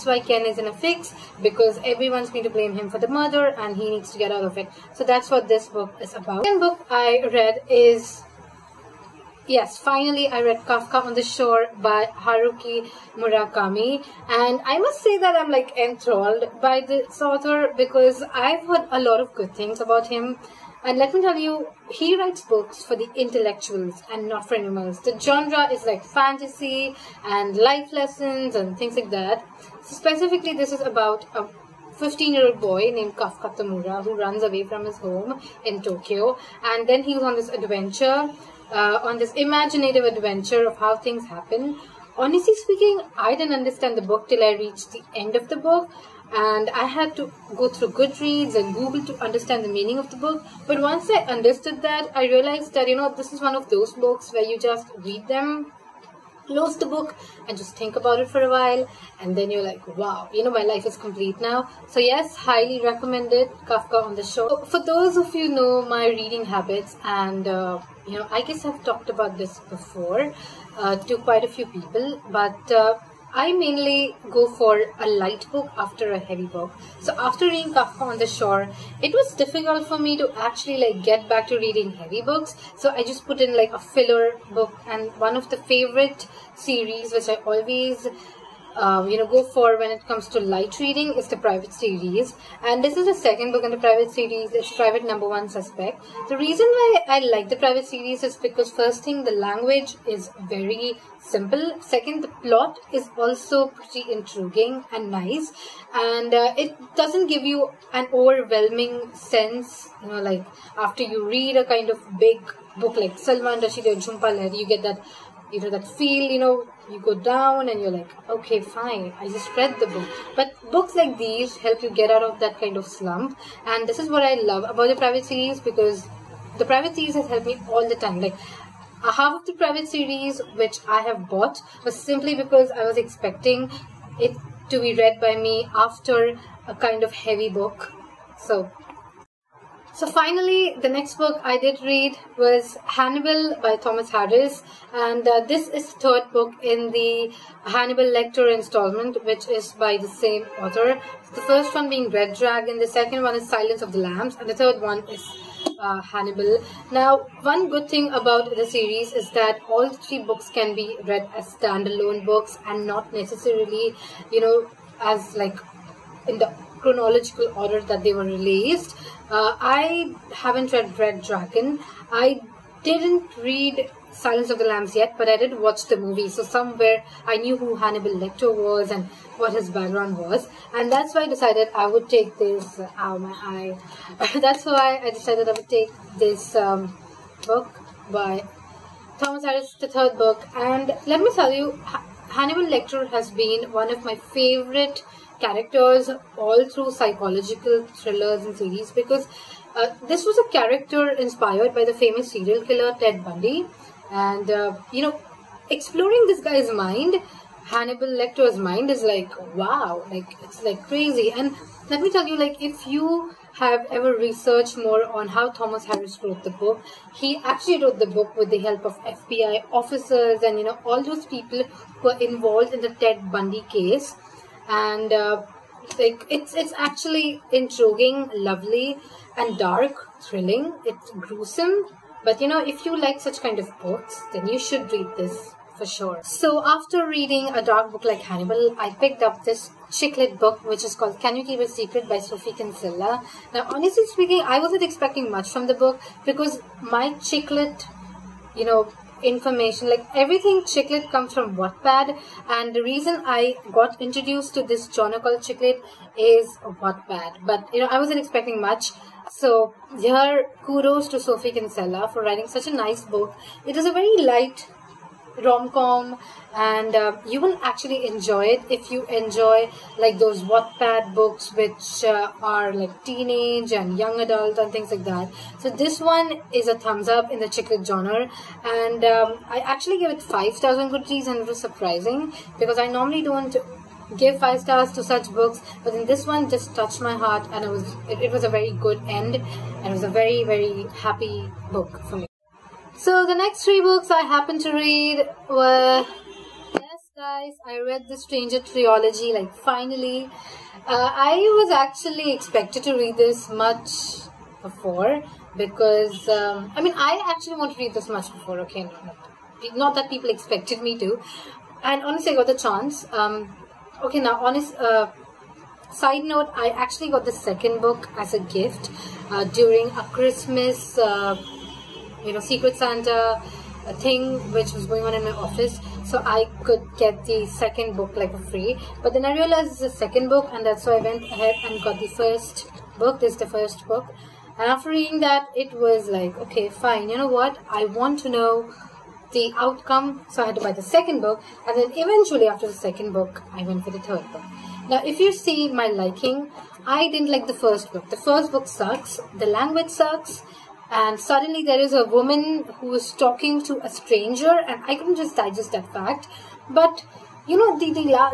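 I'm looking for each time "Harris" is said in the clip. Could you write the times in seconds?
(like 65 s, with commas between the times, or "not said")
144 s, 189 s, 215 s.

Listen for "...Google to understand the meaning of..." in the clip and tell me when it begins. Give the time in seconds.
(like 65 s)
48 s.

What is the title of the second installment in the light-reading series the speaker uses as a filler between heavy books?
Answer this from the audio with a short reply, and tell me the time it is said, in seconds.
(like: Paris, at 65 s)
Private Number One Suspect, at 94 s.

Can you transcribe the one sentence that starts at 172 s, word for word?
I didn't read Silence of the Lambs yet, but I did watch the movie.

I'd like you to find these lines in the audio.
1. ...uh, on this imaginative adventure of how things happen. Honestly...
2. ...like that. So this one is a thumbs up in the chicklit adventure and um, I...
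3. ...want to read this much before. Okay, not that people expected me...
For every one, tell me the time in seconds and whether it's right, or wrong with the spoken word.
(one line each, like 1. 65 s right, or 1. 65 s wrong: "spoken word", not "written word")
1. 38 s right
2. 274 s wrong: "genre", not "adventure"
3. 307 s right.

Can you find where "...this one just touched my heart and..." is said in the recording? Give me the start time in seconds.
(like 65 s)
286 s.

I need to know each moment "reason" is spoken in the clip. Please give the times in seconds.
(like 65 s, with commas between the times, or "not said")
96 s, 252 s.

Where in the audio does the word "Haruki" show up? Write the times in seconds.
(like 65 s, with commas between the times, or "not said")
12 s.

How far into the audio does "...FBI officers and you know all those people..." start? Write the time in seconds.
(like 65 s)
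219 s.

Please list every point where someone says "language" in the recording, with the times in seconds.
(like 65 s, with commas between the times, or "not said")
99 s, 349 s.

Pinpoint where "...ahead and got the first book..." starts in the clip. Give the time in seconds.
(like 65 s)
331 s.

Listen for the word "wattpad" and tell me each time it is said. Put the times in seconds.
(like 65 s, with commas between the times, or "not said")
251 s, 256 s, 270 s.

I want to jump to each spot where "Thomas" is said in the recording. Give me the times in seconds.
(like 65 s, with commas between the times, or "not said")
143 s, 189 s, 215 s.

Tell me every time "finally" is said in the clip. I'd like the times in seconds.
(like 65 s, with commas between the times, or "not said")
9 s, 140 s, 299 s.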